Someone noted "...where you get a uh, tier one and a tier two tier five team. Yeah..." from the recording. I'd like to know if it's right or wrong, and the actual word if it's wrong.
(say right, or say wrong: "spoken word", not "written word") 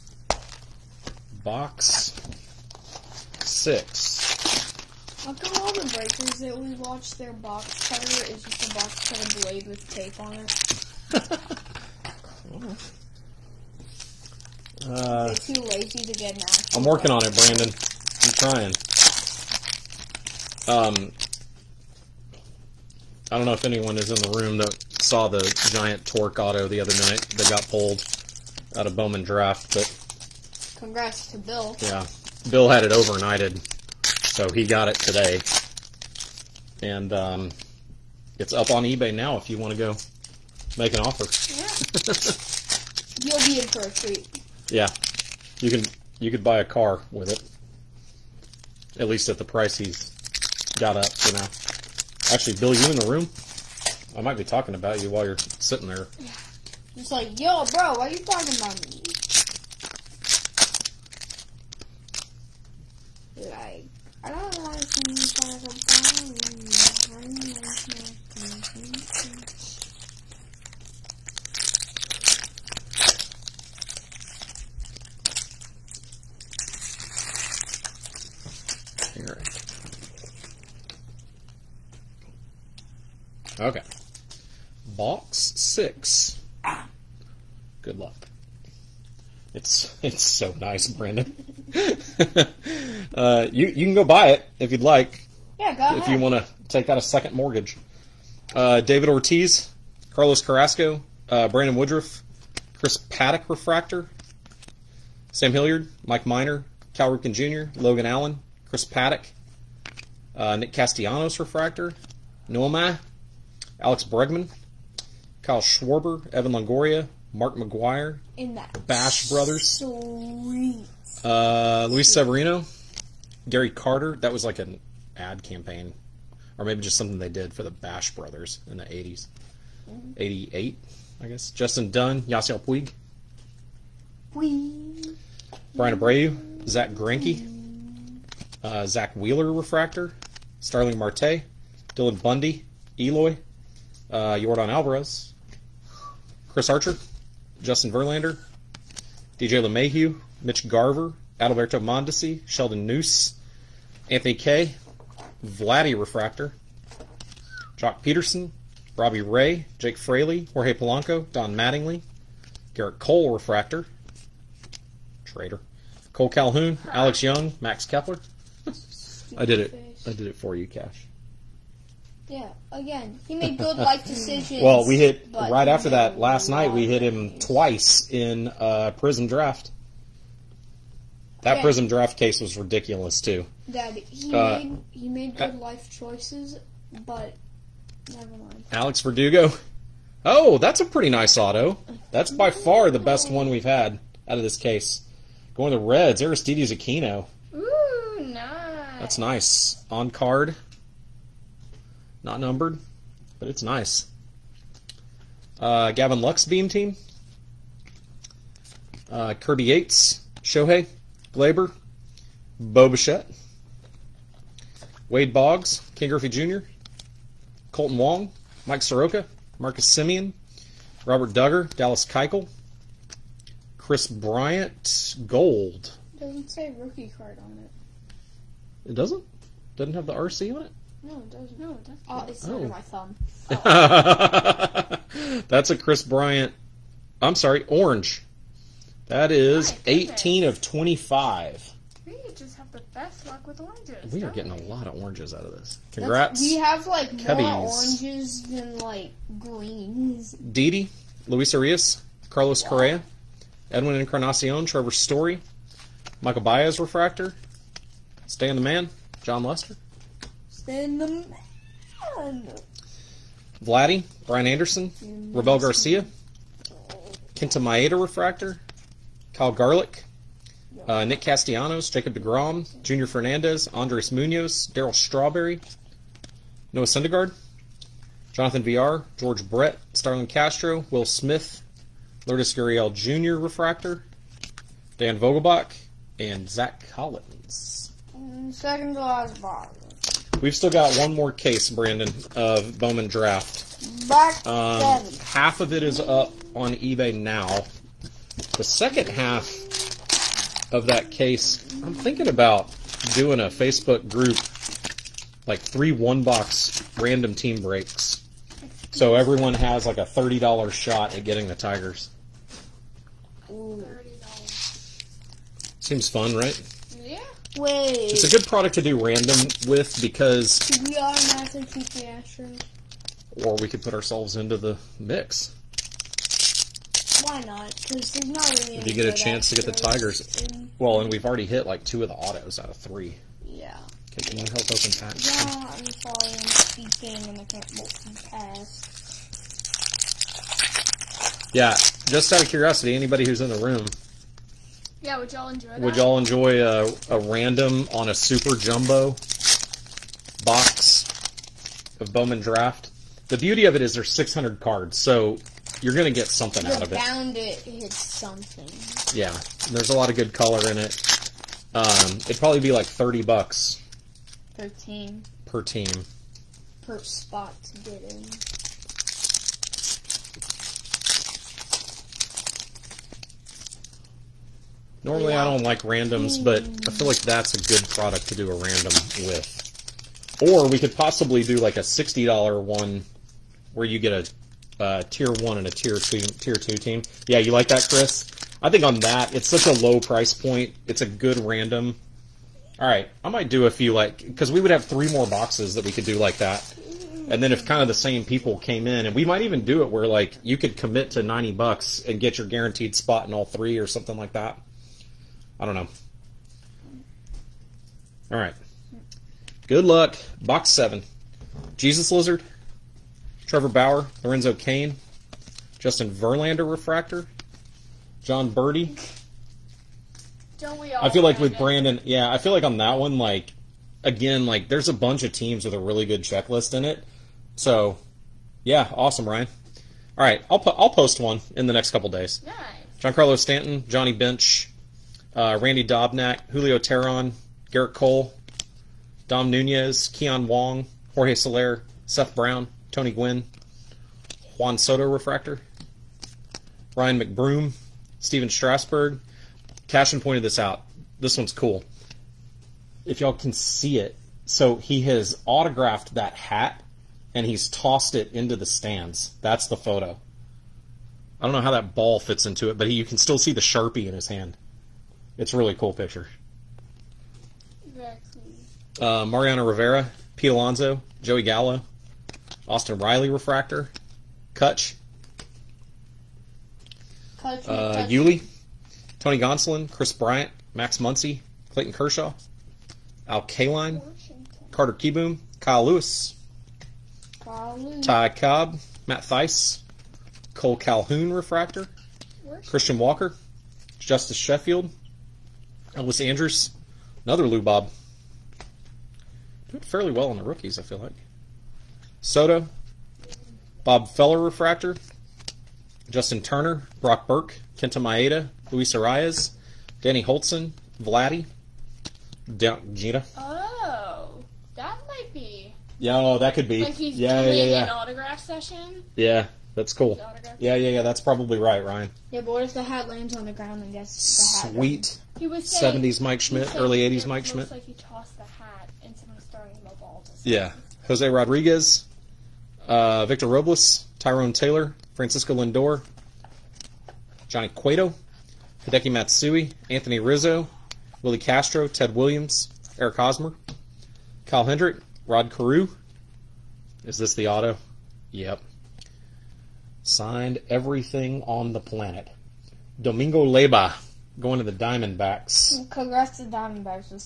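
wrong: "two", not "five".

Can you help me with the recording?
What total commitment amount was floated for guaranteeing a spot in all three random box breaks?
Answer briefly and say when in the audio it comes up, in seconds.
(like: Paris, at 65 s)
$90, at 401 s.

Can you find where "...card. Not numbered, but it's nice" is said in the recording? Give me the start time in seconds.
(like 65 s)
200 s.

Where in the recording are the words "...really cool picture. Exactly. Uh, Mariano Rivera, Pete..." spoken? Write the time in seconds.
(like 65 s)
465 s.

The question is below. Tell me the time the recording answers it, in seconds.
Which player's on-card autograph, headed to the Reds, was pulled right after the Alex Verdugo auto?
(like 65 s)
196 s.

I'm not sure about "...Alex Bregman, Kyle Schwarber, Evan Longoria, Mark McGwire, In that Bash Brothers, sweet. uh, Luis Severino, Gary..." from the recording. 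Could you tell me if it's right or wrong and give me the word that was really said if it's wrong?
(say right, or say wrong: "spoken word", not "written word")
right.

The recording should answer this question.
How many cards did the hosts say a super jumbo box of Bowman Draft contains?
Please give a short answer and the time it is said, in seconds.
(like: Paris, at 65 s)
600, at 354 s.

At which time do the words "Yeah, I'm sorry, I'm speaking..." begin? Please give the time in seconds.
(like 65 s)
335 s.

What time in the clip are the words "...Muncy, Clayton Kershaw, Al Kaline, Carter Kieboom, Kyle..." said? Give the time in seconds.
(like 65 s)
480 s.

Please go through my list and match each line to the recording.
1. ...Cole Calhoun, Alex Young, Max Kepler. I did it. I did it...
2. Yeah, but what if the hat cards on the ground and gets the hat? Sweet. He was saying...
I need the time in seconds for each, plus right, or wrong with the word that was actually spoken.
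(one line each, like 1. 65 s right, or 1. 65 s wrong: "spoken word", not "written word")
1. 166 s right
2. 522 s wrong: "lands", not "cards".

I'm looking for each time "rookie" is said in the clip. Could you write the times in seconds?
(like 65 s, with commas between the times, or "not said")
226 s, 500 s.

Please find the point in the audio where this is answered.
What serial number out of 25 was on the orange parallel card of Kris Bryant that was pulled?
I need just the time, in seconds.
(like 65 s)
239 s.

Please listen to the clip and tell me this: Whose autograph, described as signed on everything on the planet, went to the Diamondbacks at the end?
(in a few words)
Domingo Leyba.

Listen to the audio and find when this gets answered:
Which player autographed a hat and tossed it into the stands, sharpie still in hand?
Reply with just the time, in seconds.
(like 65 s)
448 s.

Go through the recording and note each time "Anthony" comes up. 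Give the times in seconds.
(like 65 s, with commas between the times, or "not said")
154 s, 539 s.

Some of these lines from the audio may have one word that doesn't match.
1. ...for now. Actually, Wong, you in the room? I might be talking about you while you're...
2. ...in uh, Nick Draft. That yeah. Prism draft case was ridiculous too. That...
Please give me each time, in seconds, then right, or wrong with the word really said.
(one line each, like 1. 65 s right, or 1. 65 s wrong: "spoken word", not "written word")
1. 51 s wrong: "Bill", not "Wong"
2. 178 s wrong: "Prism", not "Nick".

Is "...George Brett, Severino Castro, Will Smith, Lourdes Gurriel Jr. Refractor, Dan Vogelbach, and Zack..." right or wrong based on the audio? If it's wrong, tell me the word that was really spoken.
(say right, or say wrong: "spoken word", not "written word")
wrong: "Starlin", not "Severino".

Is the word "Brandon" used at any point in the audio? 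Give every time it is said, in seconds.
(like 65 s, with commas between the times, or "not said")
17 s, 90 s, 101 s, 291 s, 421 s.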